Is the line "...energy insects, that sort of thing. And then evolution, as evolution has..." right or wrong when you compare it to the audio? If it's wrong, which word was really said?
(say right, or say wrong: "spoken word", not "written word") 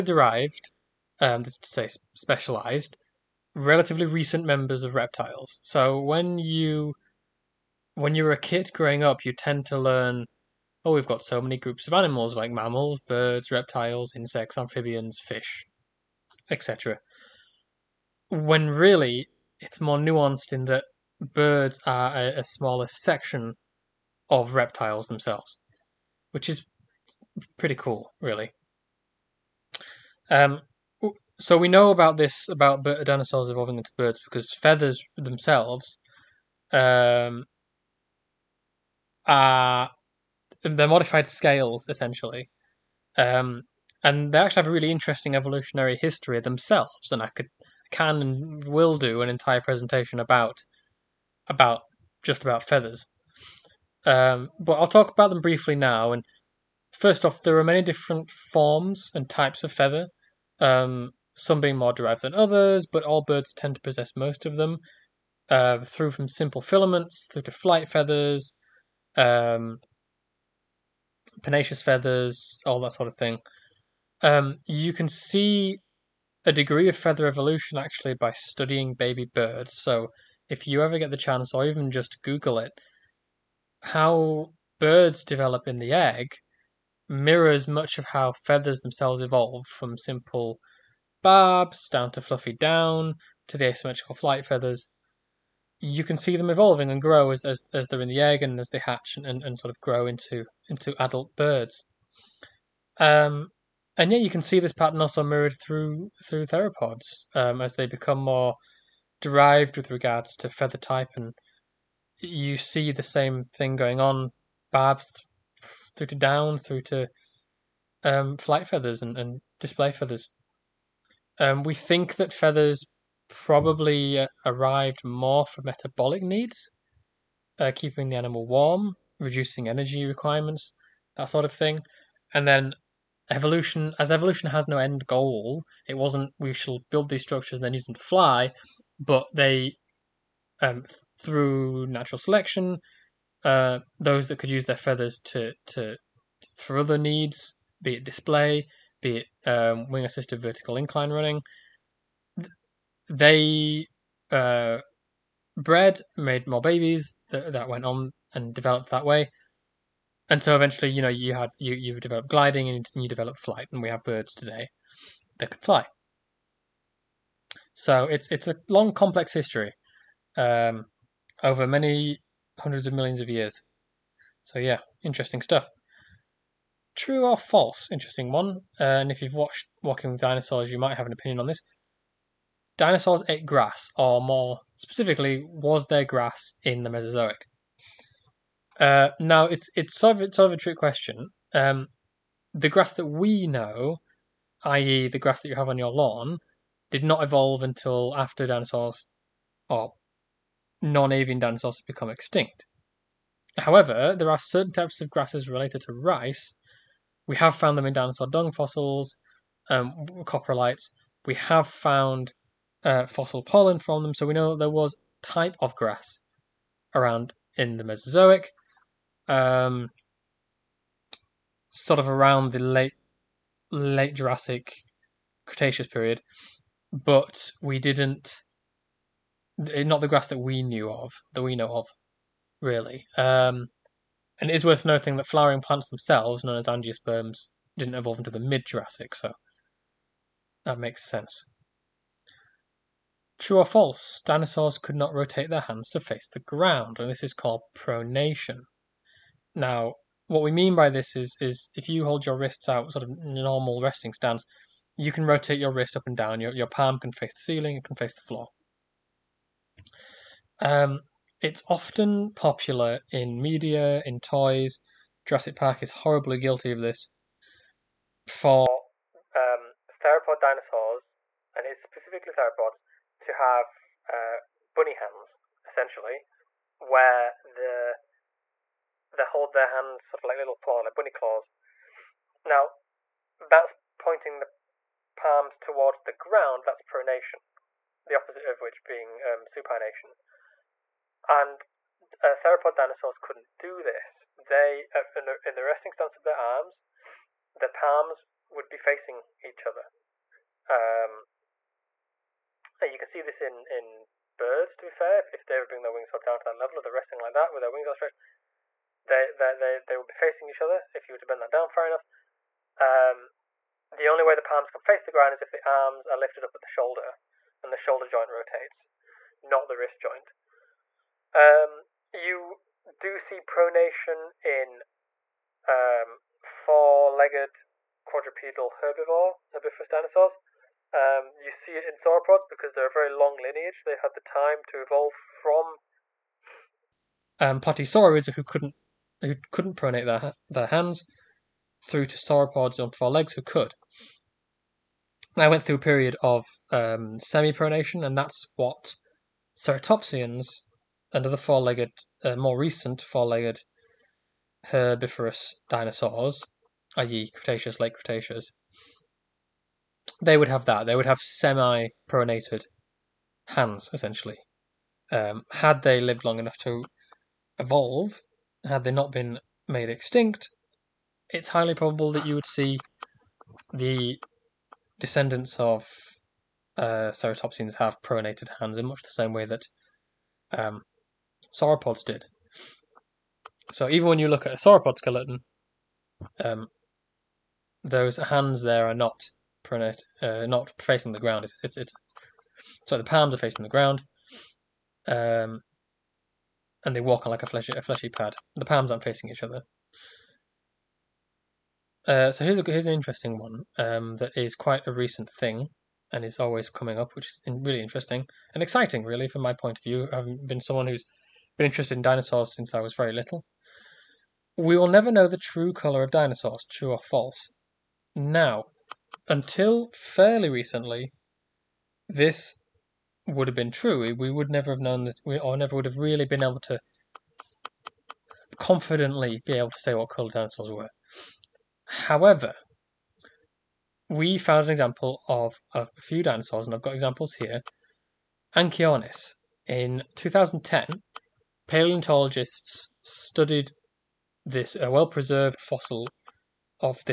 wrong: "requirements", not "insects".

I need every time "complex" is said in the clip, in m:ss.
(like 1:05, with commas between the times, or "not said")
2:48.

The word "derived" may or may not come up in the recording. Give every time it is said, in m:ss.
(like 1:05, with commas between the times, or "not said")
0:00, 1:01, 1:49.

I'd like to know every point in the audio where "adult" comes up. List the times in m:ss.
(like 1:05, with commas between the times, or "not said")
1:40.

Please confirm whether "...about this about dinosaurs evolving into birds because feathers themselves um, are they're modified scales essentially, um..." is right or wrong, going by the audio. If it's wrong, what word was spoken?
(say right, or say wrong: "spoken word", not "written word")
right.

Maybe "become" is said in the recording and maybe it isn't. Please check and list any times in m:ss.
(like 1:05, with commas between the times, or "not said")
1:47, 3:21.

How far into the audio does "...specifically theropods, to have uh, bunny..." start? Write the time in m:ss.
4:31.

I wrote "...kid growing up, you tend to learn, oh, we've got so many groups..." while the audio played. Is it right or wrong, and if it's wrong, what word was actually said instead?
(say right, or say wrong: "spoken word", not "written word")
right.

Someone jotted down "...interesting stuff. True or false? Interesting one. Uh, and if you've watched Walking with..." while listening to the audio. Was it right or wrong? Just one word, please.
right.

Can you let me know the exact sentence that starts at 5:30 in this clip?
Um, you see it in sauropods because they're a very long lineage.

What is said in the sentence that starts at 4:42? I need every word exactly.
Now, that's pointing the palms towards the ground.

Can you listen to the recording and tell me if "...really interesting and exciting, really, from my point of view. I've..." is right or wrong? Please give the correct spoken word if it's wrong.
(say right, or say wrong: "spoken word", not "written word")
right.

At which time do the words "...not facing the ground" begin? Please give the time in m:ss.
6:30.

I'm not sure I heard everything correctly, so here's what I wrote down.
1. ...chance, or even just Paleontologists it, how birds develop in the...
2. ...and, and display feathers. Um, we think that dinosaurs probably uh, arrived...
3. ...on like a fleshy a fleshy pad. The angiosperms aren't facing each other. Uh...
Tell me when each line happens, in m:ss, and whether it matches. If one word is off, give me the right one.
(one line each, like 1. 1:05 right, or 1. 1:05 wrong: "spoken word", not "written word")
1. 1:21 wrong: "Google", not "Paleontologists"
2. 1:59 wrong: "feathers", not "dinosaurs"
3. 6:37 wrong: "palms", not "angiosperms".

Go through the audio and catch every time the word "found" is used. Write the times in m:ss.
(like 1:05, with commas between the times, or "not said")
3:27, 3:31, 7:14.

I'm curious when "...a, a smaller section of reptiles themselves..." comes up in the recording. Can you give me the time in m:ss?
0:22.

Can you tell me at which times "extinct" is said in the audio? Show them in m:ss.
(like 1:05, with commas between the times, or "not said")
3:22, 6:09.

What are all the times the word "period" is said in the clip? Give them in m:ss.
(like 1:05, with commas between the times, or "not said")
3:45, 5:45.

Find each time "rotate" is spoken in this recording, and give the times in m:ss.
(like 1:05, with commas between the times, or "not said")
4:05, 4:15, 5:18.